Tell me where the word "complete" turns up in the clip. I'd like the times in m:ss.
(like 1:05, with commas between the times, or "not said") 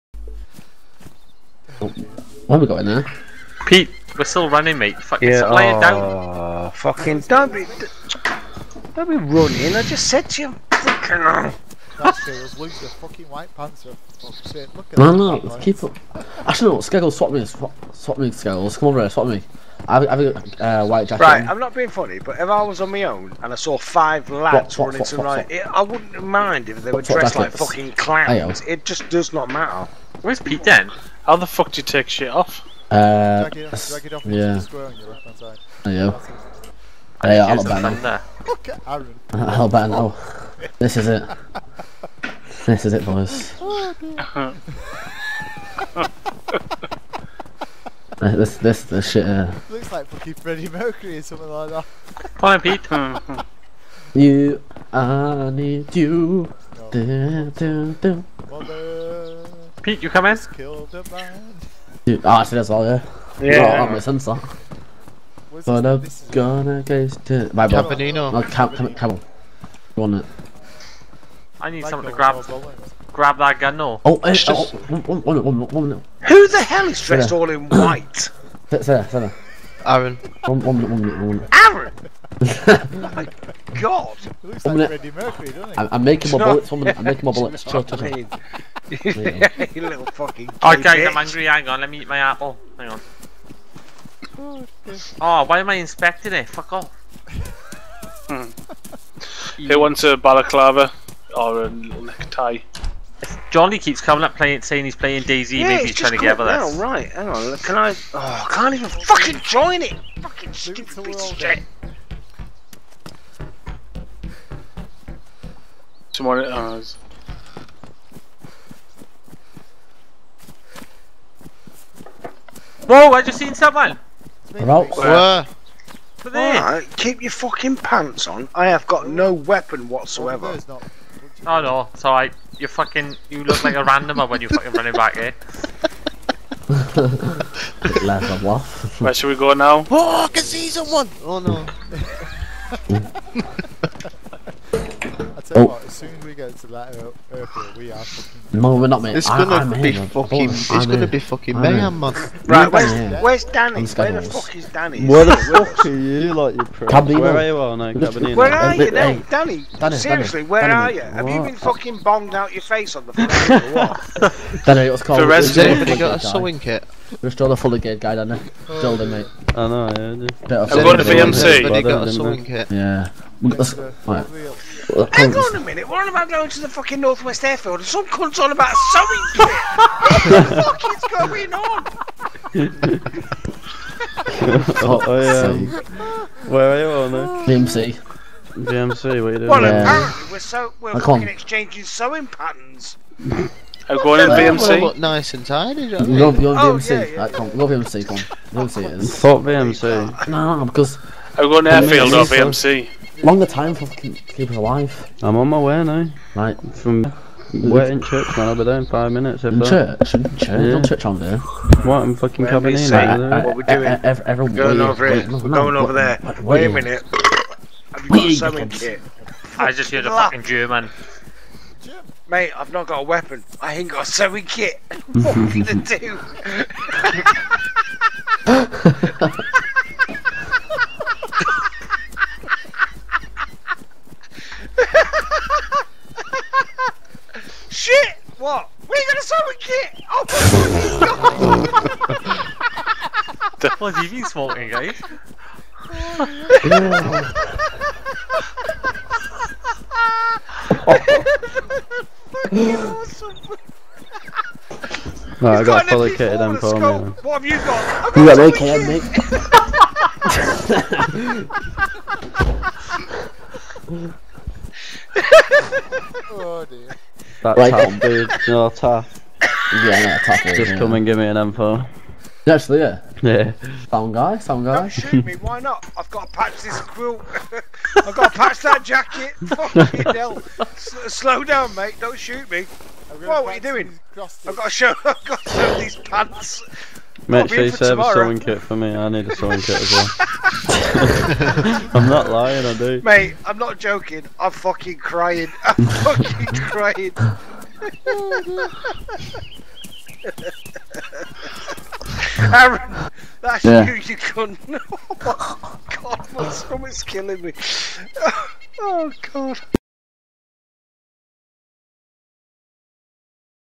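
not said.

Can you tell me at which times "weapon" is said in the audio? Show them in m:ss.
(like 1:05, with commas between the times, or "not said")
2:09, 3:43.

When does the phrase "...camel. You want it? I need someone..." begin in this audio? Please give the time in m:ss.
1:08.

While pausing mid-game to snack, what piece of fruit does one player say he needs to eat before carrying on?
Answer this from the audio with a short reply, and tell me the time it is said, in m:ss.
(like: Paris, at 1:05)
Apple, at 1:32.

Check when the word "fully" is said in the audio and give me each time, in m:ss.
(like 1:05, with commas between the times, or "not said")
2:47, 4:15.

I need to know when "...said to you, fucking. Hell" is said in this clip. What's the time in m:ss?
0:10.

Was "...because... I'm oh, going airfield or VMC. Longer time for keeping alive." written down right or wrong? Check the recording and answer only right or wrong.
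right.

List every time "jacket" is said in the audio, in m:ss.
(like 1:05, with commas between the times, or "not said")
0:21, 4:38.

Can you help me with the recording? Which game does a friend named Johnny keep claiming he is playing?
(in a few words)
DayZ.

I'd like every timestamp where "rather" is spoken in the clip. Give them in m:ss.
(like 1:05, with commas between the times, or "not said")
not said.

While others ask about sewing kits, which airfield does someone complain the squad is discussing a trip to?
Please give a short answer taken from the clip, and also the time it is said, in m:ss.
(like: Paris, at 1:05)
Northwest Airfield, at 2:56.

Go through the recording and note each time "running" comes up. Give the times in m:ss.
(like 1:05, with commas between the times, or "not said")
0:04, 0:09, 0:24, 2:14.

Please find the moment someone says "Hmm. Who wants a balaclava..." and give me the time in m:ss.
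1:38.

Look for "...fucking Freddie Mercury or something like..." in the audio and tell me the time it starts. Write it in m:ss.
0:50.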